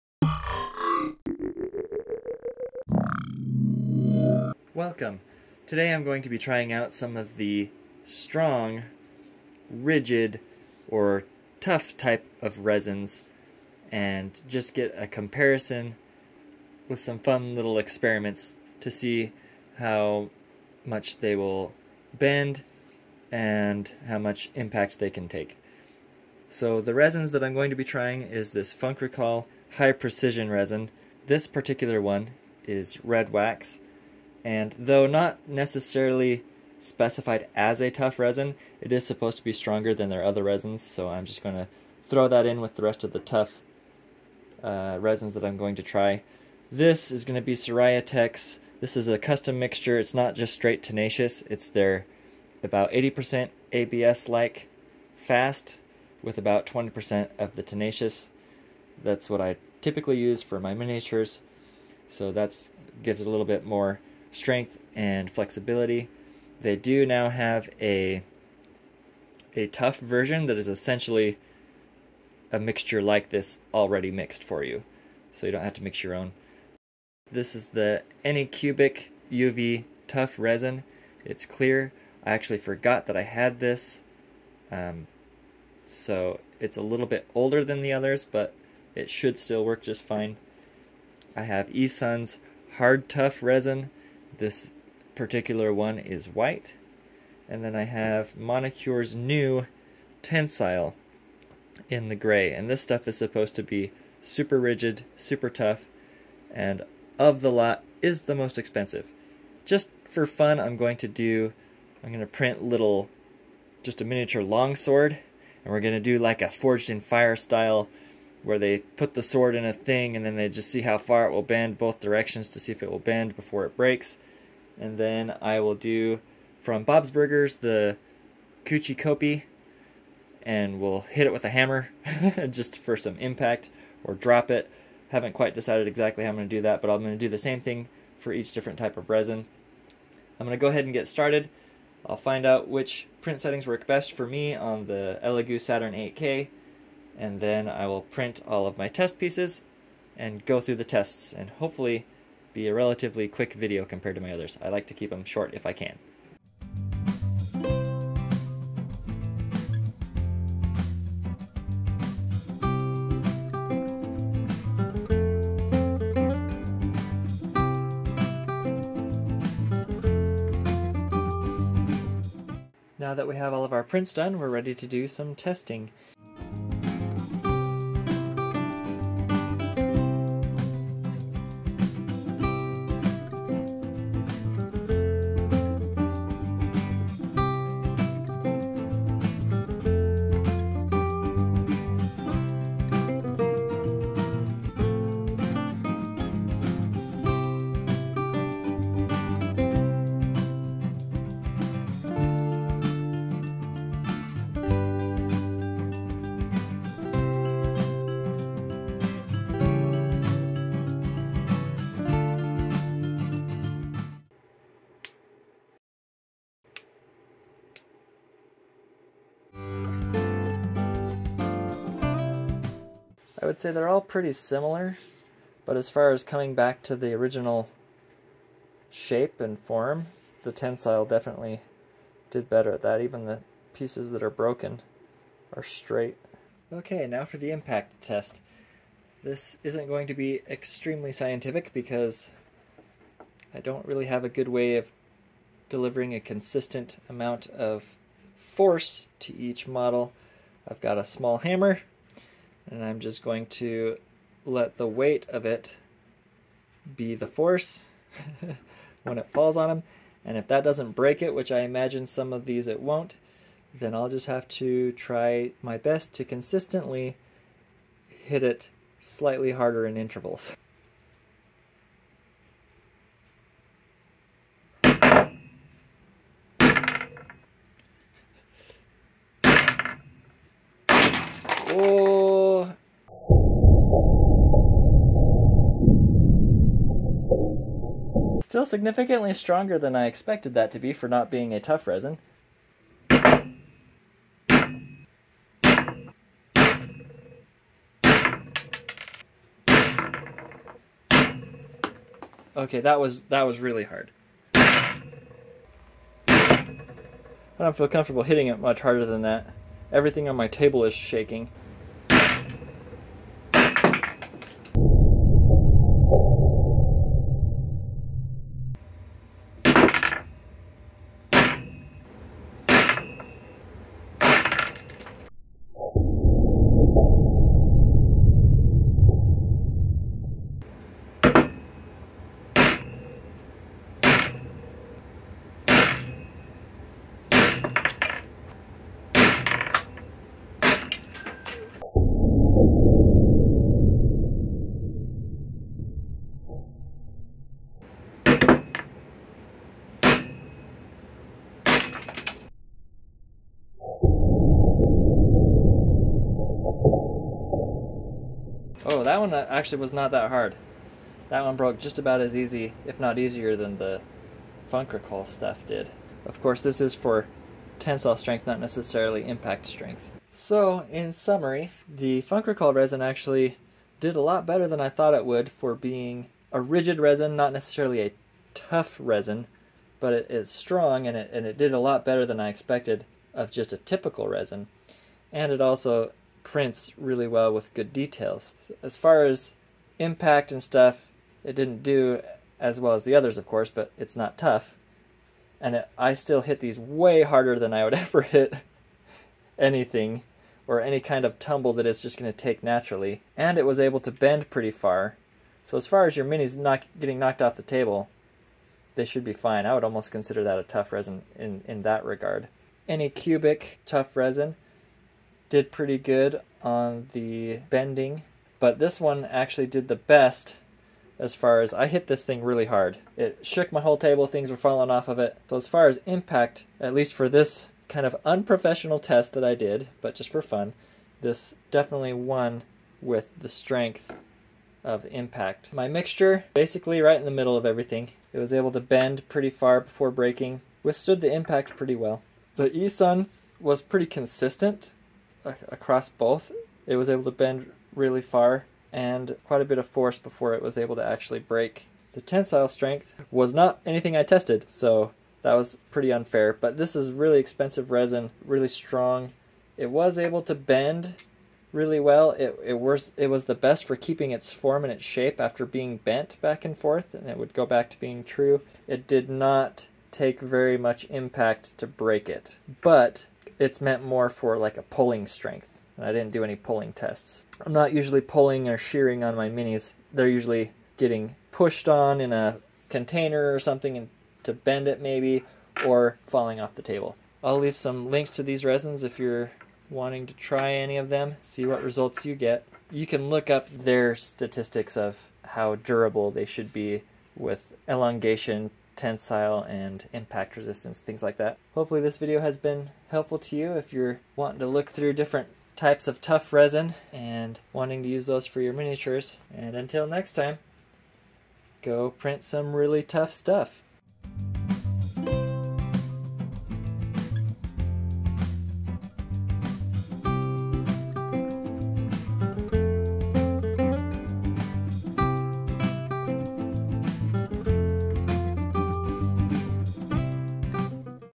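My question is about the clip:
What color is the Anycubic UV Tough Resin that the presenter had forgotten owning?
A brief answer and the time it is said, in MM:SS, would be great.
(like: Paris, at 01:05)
clear, at 01:21.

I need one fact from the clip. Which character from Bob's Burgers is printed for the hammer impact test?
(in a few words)
Kuchi Kopi.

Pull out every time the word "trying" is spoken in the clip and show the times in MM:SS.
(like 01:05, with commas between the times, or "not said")
00:06, 00:27.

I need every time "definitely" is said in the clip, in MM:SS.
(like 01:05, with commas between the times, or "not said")
03:51, 07:11.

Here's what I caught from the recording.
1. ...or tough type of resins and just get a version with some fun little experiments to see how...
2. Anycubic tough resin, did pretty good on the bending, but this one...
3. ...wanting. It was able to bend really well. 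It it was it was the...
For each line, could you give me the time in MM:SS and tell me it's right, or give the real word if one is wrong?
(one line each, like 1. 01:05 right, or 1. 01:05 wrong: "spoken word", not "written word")
1. 00:10 wrong: "comparison", not "version"
2. 06:52 right
3. 07:38 wrong: "strong", not "wanting".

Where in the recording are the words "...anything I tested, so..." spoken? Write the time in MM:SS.
07:33.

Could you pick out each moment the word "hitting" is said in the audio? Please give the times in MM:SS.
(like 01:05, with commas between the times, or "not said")
05:08.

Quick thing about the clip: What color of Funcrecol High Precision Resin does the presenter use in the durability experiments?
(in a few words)
red wax.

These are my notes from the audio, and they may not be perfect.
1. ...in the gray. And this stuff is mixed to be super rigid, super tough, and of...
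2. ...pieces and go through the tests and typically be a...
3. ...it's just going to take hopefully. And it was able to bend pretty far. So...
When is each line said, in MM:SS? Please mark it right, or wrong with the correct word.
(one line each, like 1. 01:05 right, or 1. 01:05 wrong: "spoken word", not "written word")
1. 01:41 wrong: "supposed", not "mixed"
2. 02:29 wrong: "hopefully", not "typically"
3. 06:41 wrong: "naturally", not "hopefully".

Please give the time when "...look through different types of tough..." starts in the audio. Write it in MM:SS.
08:24.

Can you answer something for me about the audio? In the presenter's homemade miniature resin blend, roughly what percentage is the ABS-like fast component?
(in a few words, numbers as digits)
80%.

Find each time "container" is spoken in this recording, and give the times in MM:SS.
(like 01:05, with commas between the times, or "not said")
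08:02.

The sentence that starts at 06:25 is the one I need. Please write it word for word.
And it also prints really well with good details.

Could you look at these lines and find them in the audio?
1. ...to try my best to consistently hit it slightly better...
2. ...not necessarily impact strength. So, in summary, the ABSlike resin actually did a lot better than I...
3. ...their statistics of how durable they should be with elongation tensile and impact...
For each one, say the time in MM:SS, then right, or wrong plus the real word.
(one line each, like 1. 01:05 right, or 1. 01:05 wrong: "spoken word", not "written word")
1. 04:24 wrong: "harder", not "better"
2. 06:08 wrong: "Funcrecol", not "ABSlike"
3. 08:13 right.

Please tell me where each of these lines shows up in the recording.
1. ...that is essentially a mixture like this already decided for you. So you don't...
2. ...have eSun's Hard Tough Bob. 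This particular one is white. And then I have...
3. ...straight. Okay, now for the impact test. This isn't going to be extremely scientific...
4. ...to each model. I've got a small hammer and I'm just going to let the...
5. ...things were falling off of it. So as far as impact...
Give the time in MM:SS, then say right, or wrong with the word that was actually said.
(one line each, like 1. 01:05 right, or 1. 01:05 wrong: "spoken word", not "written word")
1. 01:10 wrong: "mixed", not "decided"
2. 01:31 wrong: "Resin", not "Bob"
3. 03:55 right
4. 04:09 right
5. 07:04 right.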